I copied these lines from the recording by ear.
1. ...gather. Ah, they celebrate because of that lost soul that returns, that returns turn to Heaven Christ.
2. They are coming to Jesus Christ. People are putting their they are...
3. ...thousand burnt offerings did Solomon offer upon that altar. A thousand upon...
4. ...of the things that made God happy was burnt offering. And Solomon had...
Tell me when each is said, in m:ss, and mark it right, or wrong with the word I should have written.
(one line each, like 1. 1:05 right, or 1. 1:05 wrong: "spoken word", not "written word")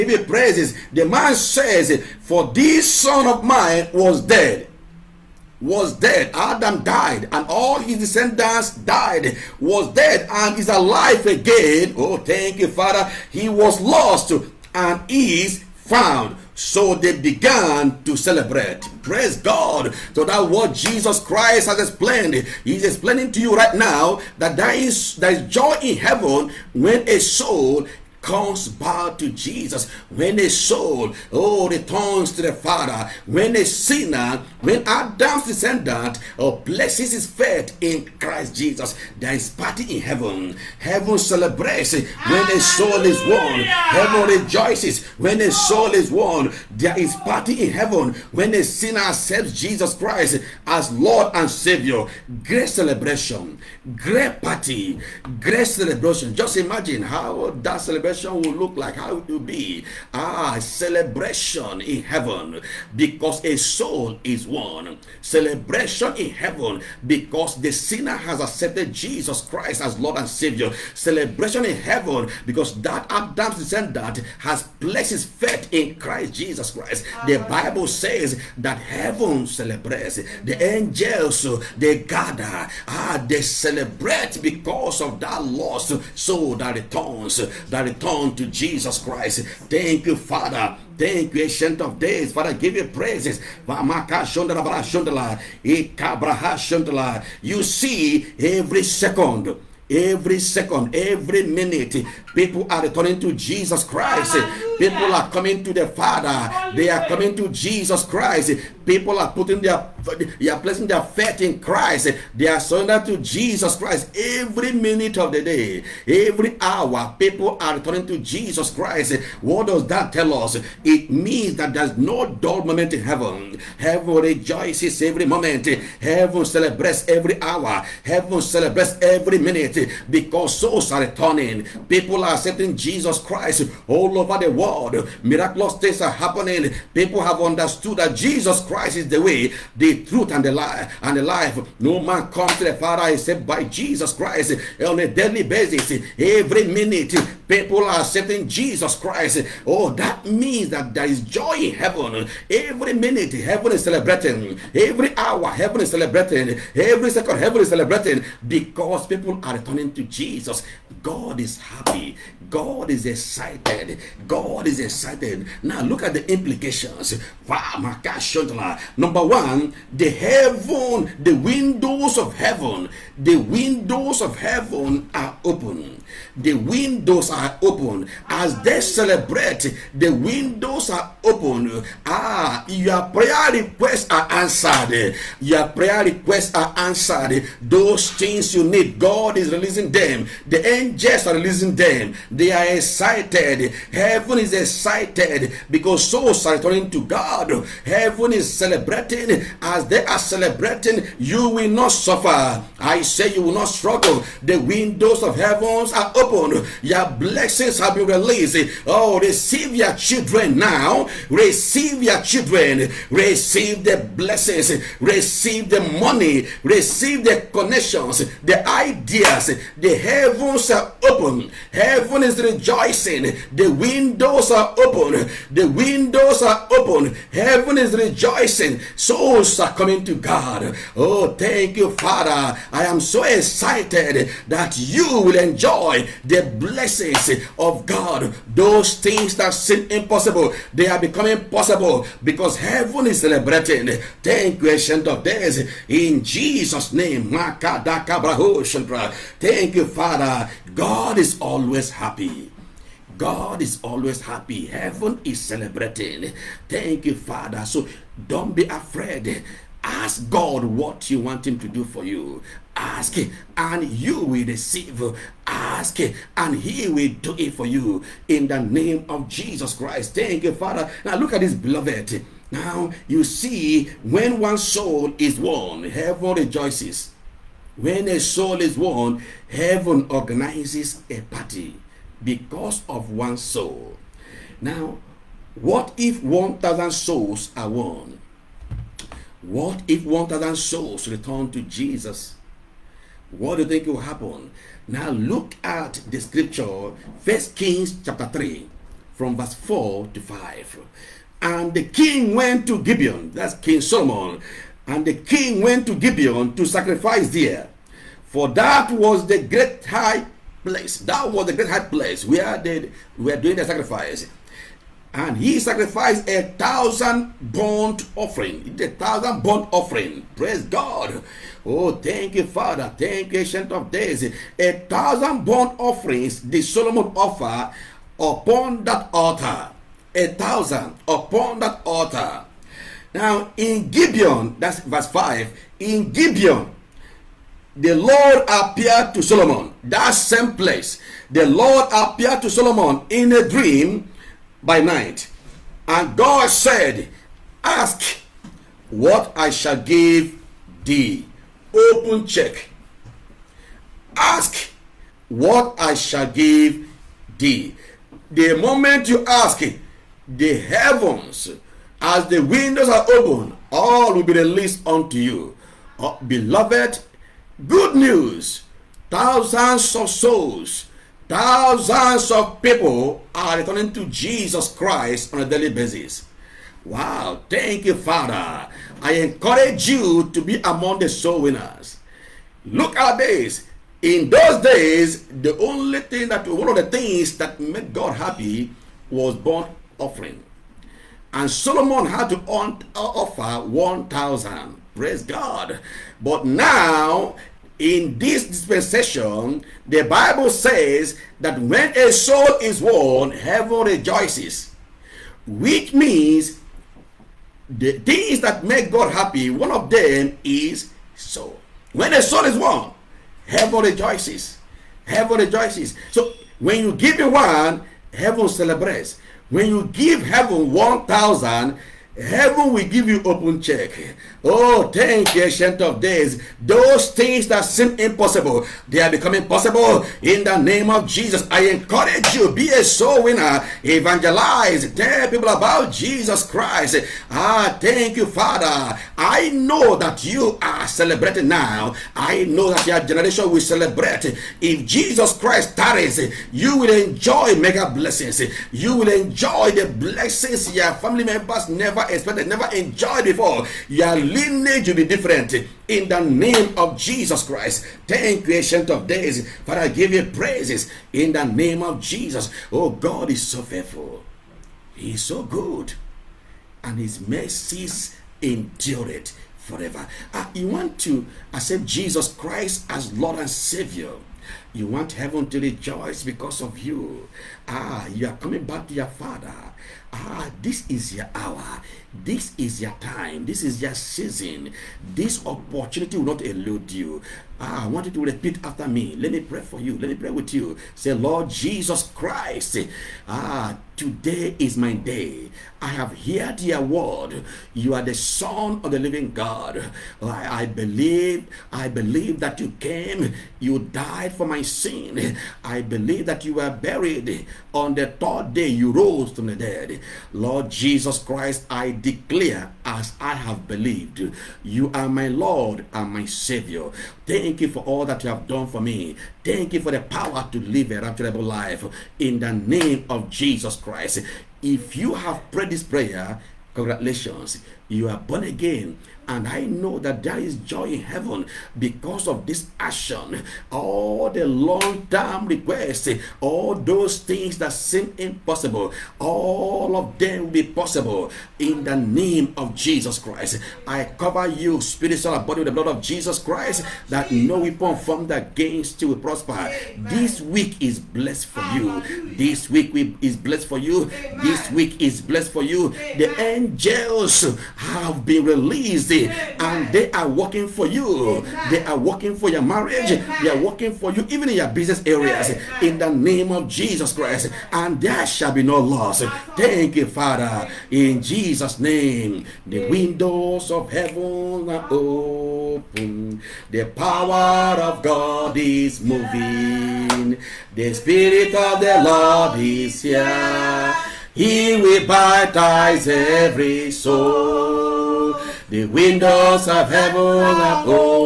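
1. 1:21 wrong: "Jesus", not "Heaven"
2. 1:46 right
3. 5:24 right
4. 6:26 right.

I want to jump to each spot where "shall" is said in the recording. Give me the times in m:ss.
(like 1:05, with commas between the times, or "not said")
5:49, 5:55, 9:28.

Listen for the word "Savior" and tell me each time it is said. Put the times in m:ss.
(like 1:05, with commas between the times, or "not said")
0:51, 1:10, 7:53, 8:36.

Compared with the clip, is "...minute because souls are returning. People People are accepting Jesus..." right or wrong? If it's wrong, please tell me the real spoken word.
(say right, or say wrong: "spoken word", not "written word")
right.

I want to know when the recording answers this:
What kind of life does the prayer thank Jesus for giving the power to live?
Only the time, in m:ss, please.
8:41.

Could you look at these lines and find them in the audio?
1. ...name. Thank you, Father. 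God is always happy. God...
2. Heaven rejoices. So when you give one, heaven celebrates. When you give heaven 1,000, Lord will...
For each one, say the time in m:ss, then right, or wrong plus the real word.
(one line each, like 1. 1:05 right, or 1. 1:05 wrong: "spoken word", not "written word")
1. 4:06 right
2. 6:55 wrong: "Heaven", not "Lord".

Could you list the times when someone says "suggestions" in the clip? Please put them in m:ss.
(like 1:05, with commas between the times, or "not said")
not said.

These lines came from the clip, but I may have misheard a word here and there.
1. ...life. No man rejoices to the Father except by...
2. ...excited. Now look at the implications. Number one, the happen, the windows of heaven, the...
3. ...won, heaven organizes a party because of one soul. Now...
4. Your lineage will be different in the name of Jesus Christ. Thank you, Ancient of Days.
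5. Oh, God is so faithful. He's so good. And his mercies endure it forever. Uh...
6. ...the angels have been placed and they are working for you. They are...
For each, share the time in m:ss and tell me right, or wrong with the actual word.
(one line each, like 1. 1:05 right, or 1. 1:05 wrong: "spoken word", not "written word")
1. 2:21 wrong: "comes", not "rejoices"
2. 2:44 wrong: "heaven", not "happen"
3. 4:38 right
4. 7:33 right
5. 7:42 right
6. 9:16 wrong: "released", not "placed".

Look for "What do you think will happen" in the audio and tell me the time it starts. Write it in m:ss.
4:53.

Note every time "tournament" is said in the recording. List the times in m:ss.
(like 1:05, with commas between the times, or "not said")
not said.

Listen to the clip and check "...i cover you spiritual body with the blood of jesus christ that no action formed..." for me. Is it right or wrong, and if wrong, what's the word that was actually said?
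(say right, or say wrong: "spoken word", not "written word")
wrong: "weapon", not "action".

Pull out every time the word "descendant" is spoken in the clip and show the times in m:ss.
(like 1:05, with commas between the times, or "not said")
0:07, 0:35, 1:13.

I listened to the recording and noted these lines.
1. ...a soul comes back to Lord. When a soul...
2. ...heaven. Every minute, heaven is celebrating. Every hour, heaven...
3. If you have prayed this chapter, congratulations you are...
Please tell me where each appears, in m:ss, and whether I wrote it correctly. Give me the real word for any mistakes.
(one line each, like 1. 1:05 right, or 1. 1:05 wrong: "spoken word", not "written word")
1. 0:27 wrong: "Jesus", not "Lord"
2. 2:31 right
3. 8:44 wrong: "prayer", not "chapter".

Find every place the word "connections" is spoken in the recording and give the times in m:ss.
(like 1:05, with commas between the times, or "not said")
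3:37.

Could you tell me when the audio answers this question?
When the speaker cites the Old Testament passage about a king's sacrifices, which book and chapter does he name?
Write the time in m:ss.
4:57.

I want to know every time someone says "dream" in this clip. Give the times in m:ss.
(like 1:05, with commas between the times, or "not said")
5:43.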